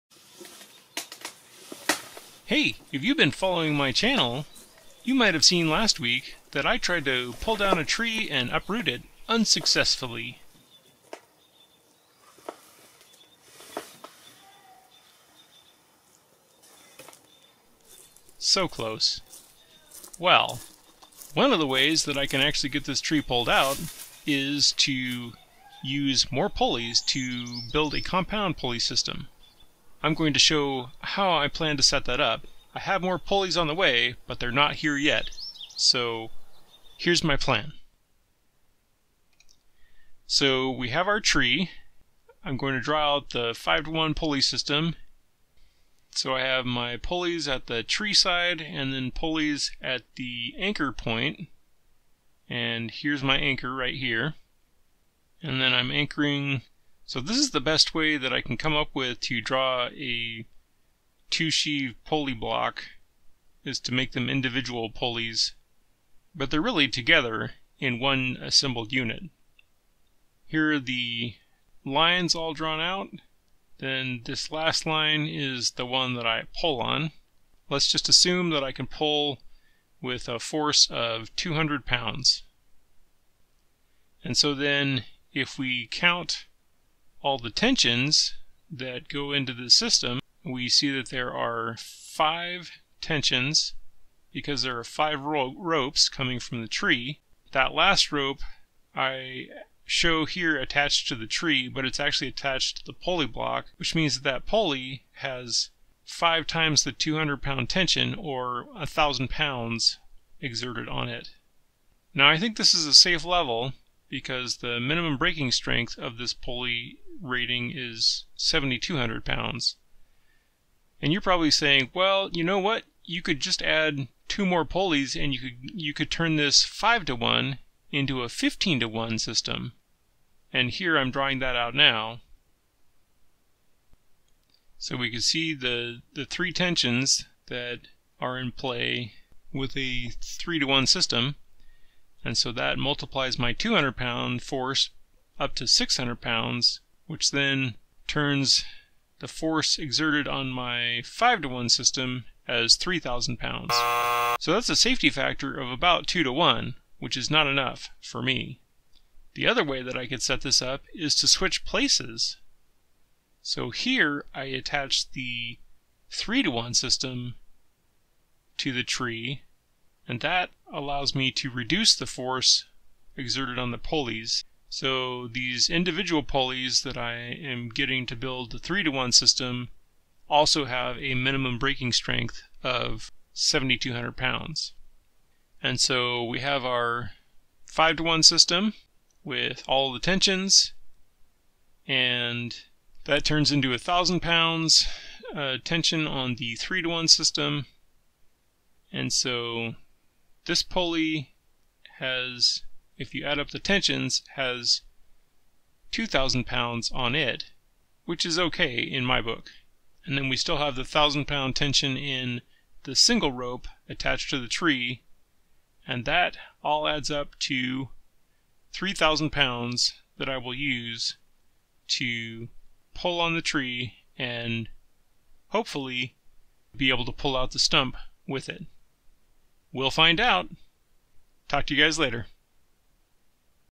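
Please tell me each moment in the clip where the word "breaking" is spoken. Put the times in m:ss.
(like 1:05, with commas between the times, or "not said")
1:55, 3:01.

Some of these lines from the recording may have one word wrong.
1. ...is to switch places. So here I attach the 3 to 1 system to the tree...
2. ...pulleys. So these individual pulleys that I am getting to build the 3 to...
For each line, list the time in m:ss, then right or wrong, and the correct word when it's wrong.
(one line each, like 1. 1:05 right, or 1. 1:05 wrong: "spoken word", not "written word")
1. 2:40 right
2. 2:53 right.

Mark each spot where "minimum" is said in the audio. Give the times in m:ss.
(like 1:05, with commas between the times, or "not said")
1:54, 3:01.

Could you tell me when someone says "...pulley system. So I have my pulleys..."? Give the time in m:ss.
0:44.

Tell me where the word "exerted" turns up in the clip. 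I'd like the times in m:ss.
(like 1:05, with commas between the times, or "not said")
1:50, 2:29, 2:53.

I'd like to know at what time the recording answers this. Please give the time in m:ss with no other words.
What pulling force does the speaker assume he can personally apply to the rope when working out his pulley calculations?
1:21.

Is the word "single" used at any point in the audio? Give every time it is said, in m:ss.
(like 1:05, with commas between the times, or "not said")
3:32.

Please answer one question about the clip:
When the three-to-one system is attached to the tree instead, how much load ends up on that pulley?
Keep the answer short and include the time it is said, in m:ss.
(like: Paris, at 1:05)
2,000 pounds, at 3:25.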